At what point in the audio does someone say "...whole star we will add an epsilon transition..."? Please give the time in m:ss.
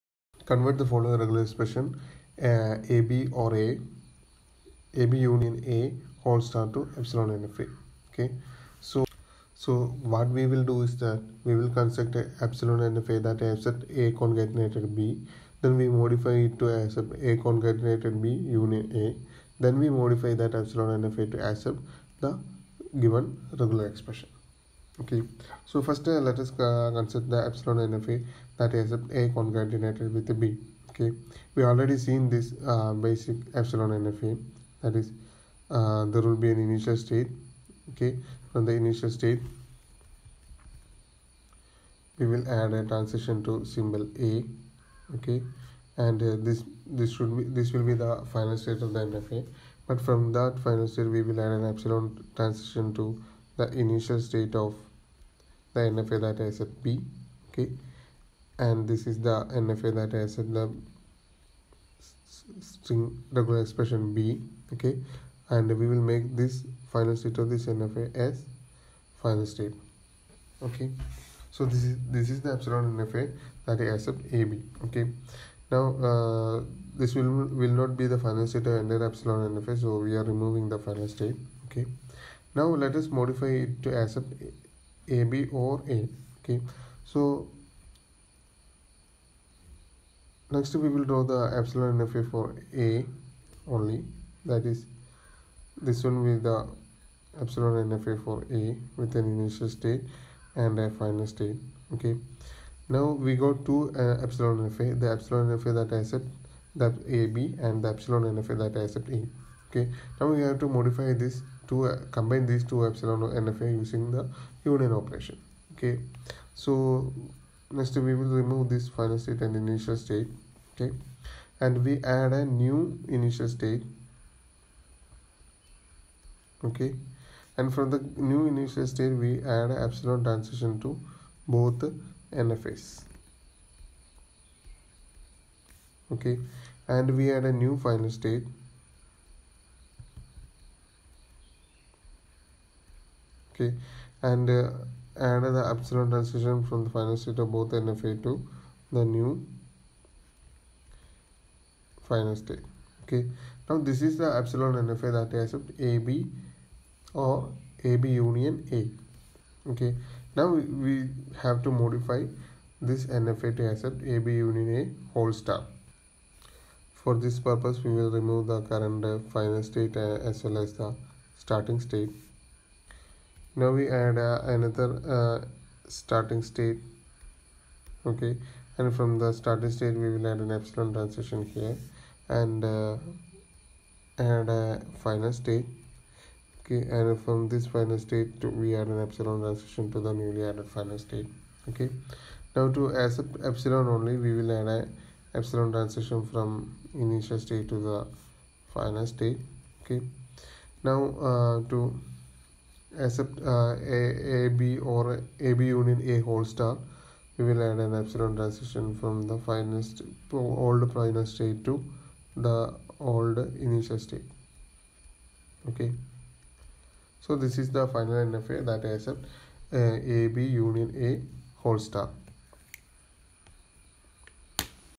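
3:26.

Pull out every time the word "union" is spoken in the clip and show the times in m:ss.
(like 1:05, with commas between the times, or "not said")
0:05, 0:18, 1:54, 2:38, 2:44, 3:25, 3:40.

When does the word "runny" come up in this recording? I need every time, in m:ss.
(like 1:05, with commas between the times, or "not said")
not said.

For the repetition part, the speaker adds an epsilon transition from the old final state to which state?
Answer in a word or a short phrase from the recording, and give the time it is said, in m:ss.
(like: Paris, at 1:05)
the old initial state, at 3:32.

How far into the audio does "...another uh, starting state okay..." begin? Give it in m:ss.
2:54.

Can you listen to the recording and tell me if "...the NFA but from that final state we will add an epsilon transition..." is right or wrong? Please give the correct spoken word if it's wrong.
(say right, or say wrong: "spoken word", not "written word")
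right.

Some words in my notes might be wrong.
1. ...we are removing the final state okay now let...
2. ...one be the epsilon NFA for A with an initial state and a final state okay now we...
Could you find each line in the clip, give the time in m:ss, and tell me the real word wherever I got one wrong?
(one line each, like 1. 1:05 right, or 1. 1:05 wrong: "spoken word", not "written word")
1. 1:19 right
2. 1:36 right.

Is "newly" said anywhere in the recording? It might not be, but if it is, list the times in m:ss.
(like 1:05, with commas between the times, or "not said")
3:10.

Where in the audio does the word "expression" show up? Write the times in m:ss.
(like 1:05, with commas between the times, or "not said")
0:01, 0:23, 1:03.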